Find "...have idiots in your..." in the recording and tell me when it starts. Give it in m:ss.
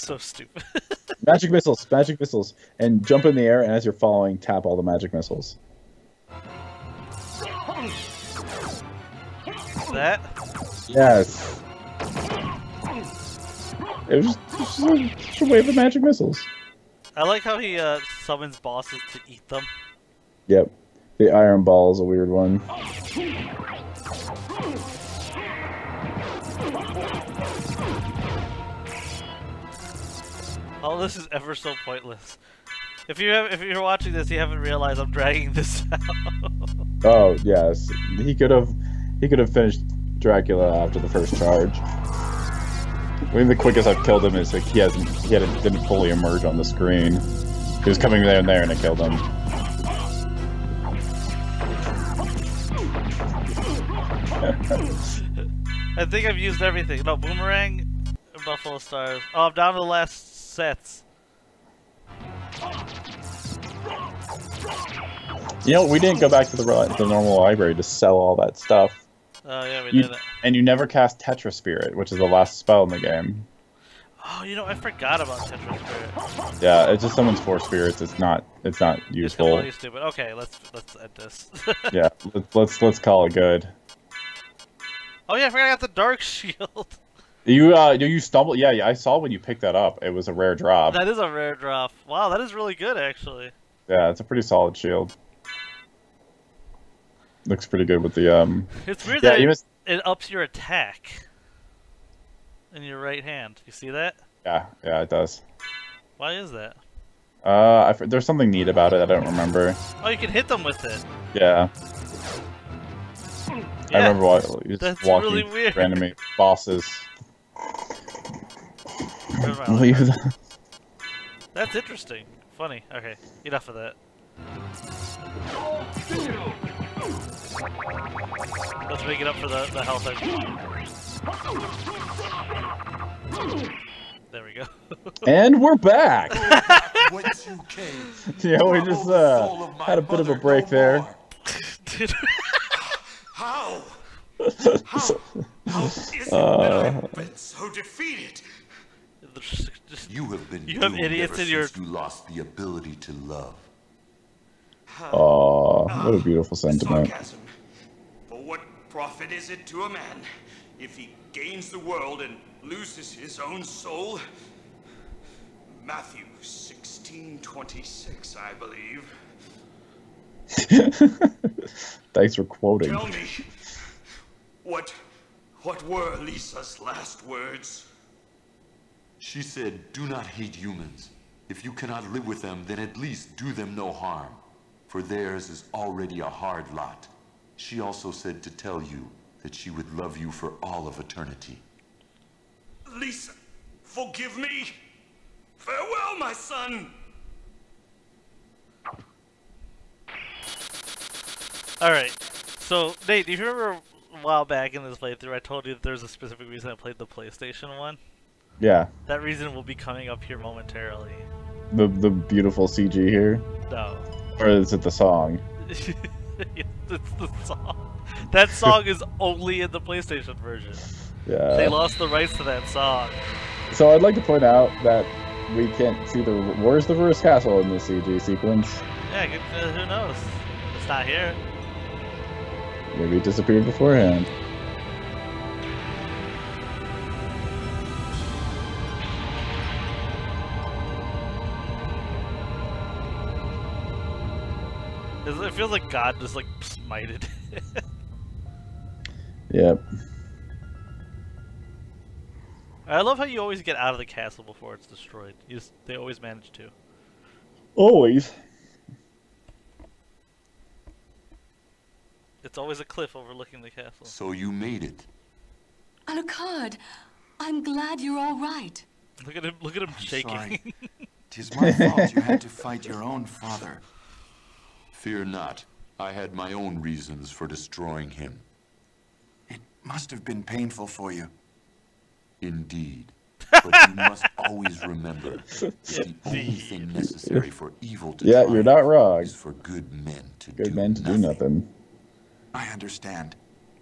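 2:30.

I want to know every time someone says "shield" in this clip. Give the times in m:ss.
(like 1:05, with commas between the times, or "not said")
1:26, 1:34.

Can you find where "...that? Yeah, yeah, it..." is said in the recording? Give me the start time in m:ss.
1:43.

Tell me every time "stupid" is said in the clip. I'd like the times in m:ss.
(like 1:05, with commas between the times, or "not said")
0:00, 1:19.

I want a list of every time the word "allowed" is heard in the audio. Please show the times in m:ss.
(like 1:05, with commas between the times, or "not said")
not said.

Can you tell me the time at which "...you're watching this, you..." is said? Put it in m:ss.
0:33.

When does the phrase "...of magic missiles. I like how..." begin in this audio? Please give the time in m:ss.
0:15.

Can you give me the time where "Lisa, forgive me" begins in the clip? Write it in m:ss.
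3:12.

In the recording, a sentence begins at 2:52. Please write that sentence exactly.
Tell me, what, what were Lisa's last words?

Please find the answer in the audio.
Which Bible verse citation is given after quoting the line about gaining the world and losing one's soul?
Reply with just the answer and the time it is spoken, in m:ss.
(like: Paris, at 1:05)
Matthew 16:26, at 2:45.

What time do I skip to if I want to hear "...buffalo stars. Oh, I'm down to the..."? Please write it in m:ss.
0:58.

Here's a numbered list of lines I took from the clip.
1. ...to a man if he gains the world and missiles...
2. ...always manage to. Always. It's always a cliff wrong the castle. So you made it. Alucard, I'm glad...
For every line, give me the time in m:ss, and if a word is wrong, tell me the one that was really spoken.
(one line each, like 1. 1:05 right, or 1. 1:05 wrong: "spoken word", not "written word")
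1. 2:39 wrong: "loses", not "missiles"
2. 4:15 wrong: "overlooking", not "wrong".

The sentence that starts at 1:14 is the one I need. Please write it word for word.
Oh, you know, I forgot about Tetra Spirit.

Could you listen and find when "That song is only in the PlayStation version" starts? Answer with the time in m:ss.
3:38.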